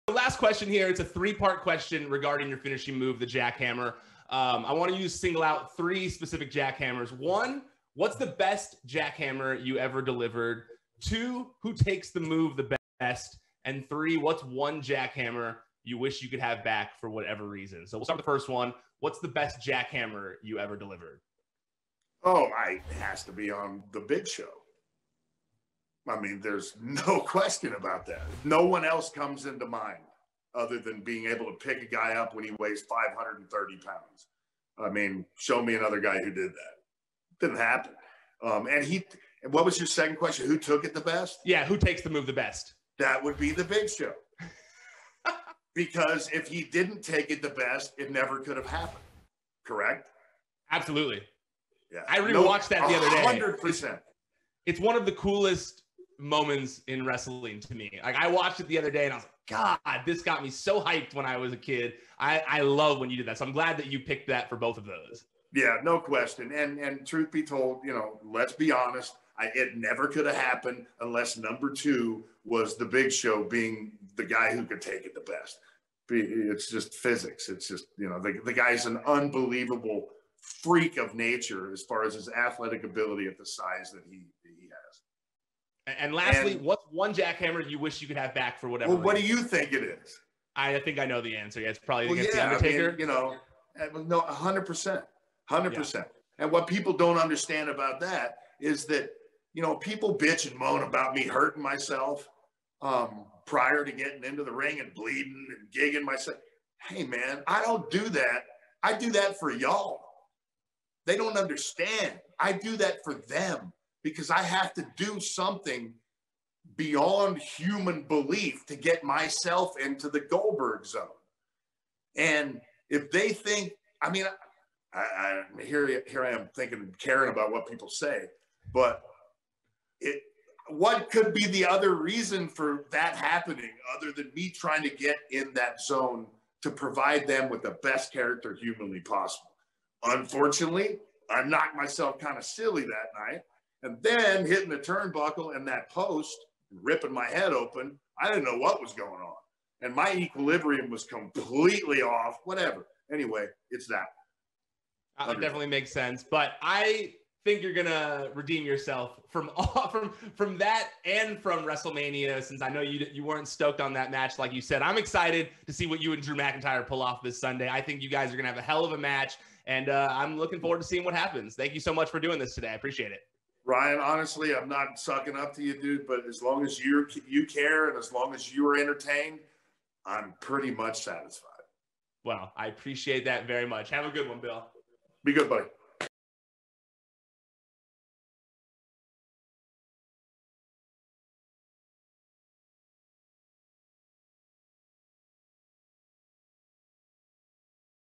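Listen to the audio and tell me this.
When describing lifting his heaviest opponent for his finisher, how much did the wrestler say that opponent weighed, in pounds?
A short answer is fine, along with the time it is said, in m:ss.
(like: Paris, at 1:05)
530 pounds, at 0:32.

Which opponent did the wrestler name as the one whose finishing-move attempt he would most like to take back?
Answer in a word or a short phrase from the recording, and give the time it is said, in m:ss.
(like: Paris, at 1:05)
The Undertaker, at 1:32.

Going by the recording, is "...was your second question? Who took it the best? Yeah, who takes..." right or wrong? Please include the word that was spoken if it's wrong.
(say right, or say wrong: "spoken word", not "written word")
right.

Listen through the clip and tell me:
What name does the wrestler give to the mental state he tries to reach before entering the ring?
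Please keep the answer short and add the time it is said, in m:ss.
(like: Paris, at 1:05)
Goldberg zone, at 2:00.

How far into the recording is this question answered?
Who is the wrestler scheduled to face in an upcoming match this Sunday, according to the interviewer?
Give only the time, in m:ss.
2:46.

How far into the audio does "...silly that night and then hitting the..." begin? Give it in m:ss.
2:22.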